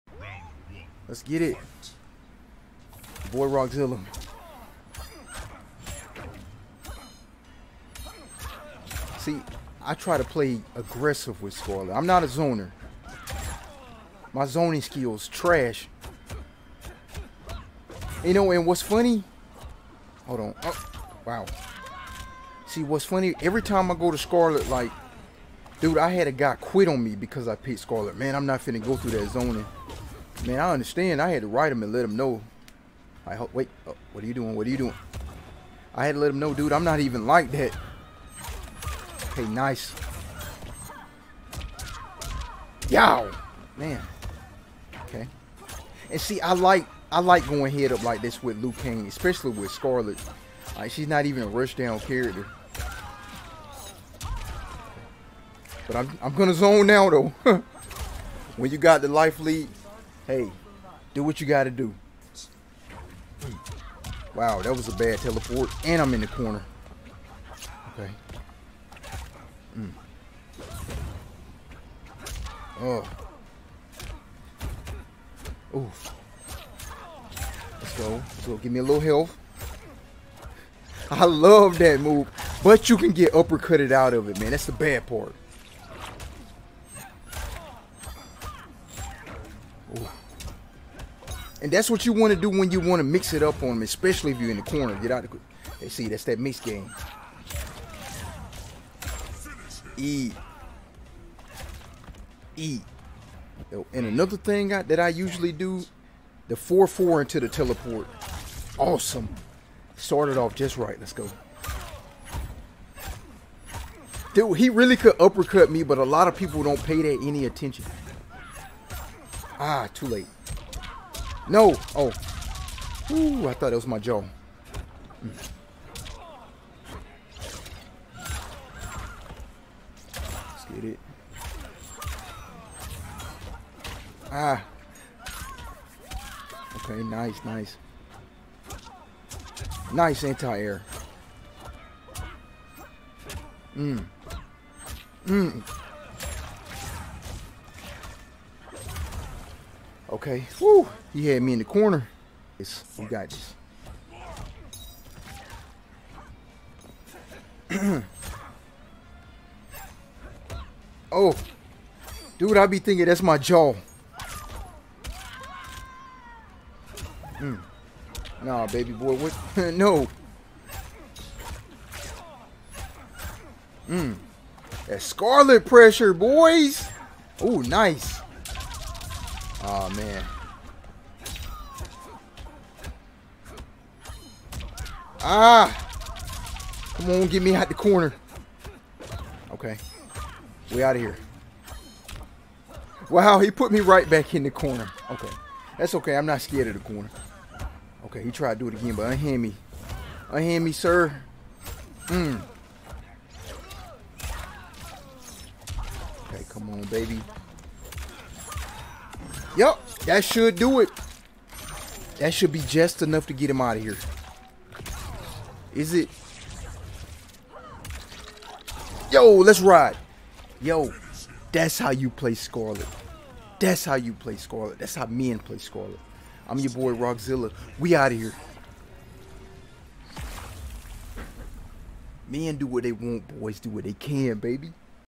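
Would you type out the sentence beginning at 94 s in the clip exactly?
Get out of the See, that's that mix game.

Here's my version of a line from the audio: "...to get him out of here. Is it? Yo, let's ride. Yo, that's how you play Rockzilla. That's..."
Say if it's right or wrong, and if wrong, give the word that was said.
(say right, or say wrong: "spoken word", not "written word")
wrong: "Skarlet", not "Rockzilla".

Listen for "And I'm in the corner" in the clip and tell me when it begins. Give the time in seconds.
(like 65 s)
65 s.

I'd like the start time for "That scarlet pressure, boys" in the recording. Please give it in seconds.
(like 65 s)
174 s.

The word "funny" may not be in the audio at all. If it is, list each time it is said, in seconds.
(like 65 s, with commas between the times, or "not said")
18 s, 23 s.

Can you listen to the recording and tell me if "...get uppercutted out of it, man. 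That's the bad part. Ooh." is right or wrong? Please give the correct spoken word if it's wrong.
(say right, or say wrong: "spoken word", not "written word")
right.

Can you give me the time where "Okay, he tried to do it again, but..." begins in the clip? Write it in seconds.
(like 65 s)
198 s.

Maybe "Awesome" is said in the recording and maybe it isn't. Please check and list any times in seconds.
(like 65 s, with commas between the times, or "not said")
108 s.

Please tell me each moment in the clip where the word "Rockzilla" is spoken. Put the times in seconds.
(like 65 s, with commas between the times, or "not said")
3 s, 226 s.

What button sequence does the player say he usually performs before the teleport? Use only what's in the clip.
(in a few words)
4-4.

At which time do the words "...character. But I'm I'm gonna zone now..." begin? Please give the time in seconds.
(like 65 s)
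51 s.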